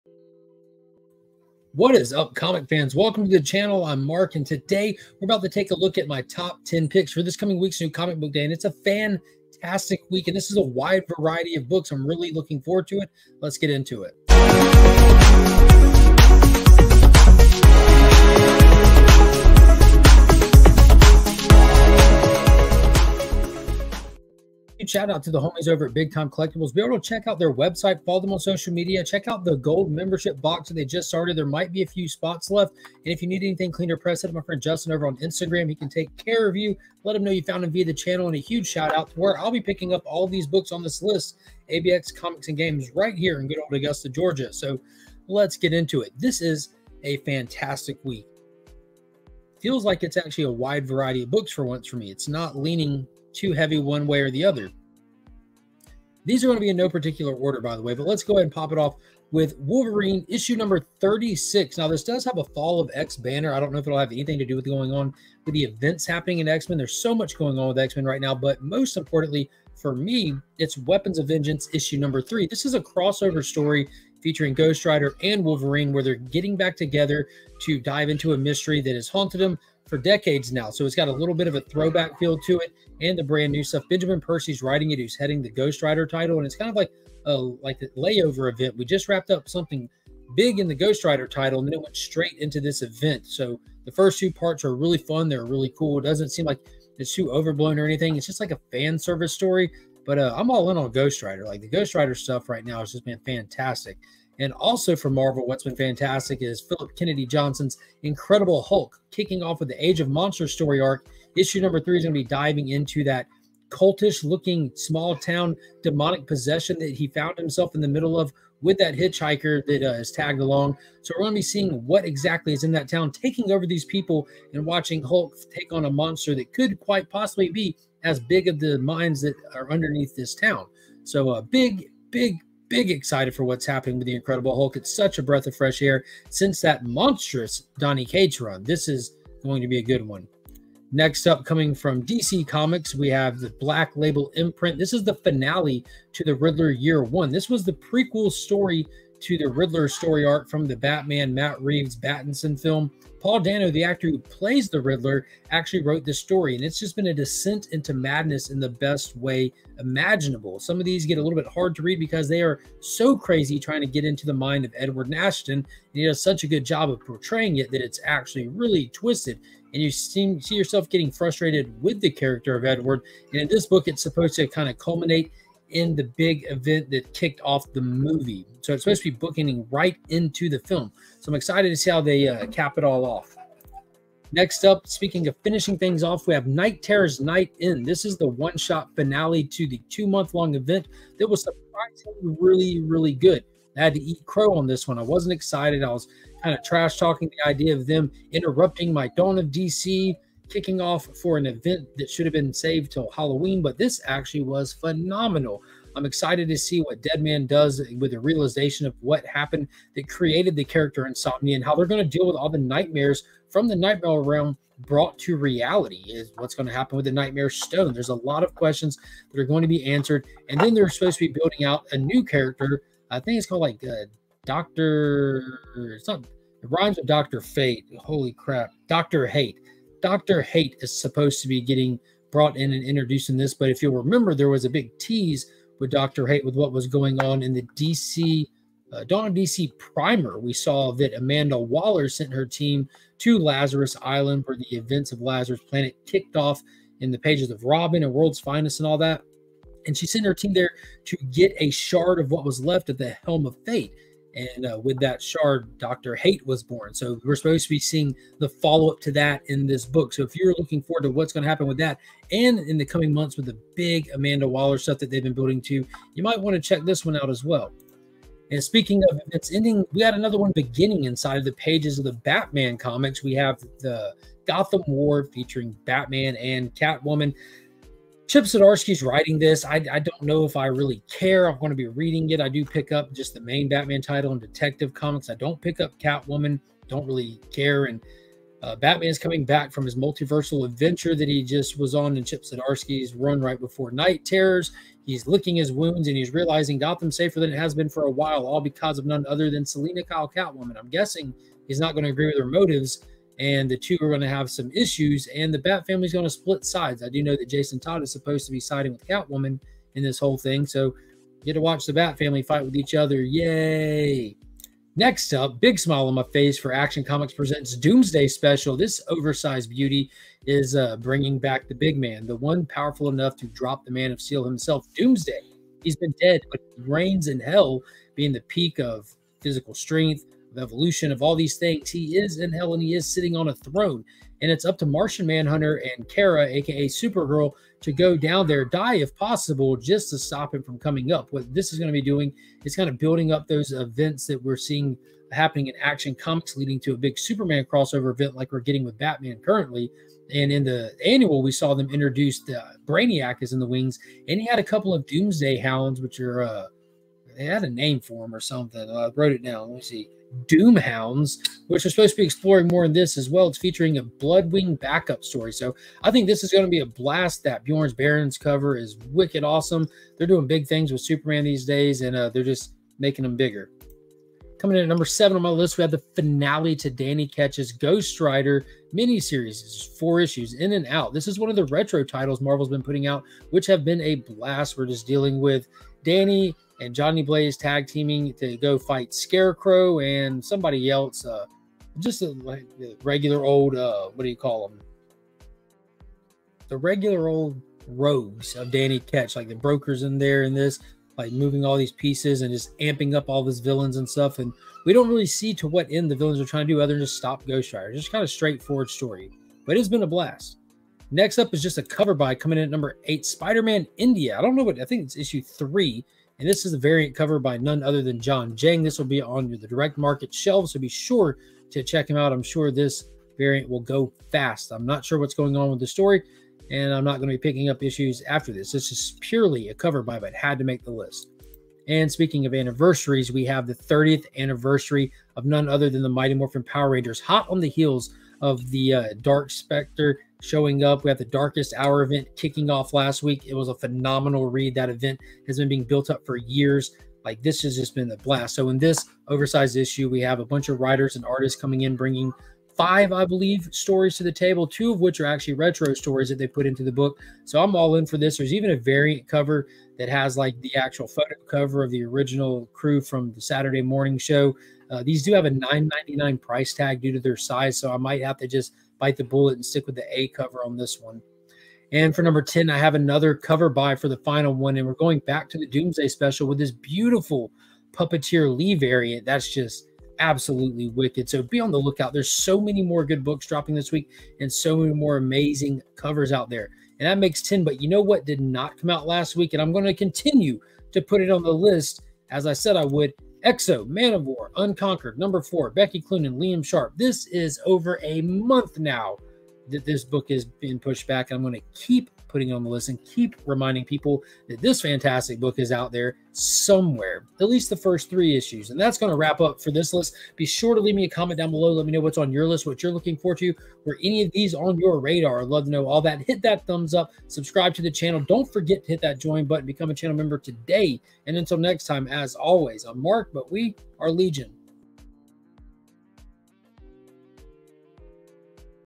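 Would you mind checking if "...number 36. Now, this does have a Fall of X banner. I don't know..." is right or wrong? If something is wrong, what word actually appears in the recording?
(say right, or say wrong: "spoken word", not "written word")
right.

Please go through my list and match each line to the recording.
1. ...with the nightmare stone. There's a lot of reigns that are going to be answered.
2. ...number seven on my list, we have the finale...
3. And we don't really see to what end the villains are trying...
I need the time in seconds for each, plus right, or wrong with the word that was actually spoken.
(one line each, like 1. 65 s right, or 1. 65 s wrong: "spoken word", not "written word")
1. 216 s wrong: "questions", not "reigns"
2. 374 s right
3. 404 s right.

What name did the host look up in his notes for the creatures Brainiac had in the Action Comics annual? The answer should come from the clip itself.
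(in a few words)
Doomhounds.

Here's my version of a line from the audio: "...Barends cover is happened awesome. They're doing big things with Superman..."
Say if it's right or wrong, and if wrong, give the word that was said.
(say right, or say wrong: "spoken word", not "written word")
wrong: "wicked", not "happened".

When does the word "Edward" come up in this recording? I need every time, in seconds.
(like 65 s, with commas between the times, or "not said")
164 s, 172 s.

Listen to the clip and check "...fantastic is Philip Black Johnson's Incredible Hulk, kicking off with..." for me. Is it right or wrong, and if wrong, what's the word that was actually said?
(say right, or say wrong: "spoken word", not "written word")
wrong: "Kennedy", not "Black".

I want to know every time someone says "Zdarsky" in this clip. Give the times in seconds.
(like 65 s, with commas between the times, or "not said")
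278 s, 292 s.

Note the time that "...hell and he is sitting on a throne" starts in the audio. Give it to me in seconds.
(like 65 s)
332 s.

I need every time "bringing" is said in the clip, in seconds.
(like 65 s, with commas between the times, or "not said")
320 s, 451 s.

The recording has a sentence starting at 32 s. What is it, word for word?
And if you need anything cleaner or pressed, hit my friend Justin over on Instagram.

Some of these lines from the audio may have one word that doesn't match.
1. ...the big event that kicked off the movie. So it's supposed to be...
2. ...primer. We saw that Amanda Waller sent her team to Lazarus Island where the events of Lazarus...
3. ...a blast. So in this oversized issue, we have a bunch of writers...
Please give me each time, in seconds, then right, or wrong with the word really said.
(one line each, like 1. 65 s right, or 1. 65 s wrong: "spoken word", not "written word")
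1. 175 s right
2. 239 s right
3. 448 s right.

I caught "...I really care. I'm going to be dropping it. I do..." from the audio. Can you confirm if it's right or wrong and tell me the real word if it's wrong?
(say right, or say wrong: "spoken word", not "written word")
wrong: "reading", not "dropping".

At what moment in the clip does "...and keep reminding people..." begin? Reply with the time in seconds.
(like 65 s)
502 s.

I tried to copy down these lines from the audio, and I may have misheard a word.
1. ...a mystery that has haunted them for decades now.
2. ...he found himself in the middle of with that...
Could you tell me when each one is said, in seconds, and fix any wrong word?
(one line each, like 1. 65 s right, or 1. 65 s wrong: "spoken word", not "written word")
1. 78 s right
2. 116 s right.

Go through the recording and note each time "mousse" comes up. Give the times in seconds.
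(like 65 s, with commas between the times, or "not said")
not said.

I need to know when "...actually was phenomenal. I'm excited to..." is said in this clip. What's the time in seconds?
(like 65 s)
204 s.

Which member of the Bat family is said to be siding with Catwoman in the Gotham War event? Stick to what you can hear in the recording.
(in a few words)
Jason Todd.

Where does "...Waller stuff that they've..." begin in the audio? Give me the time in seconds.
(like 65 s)
264 s.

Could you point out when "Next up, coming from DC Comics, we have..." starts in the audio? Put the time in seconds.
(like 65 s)
140 s.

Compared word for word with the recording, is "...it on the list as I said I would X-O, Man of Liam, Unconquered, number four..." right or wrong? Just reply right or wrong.
wrong.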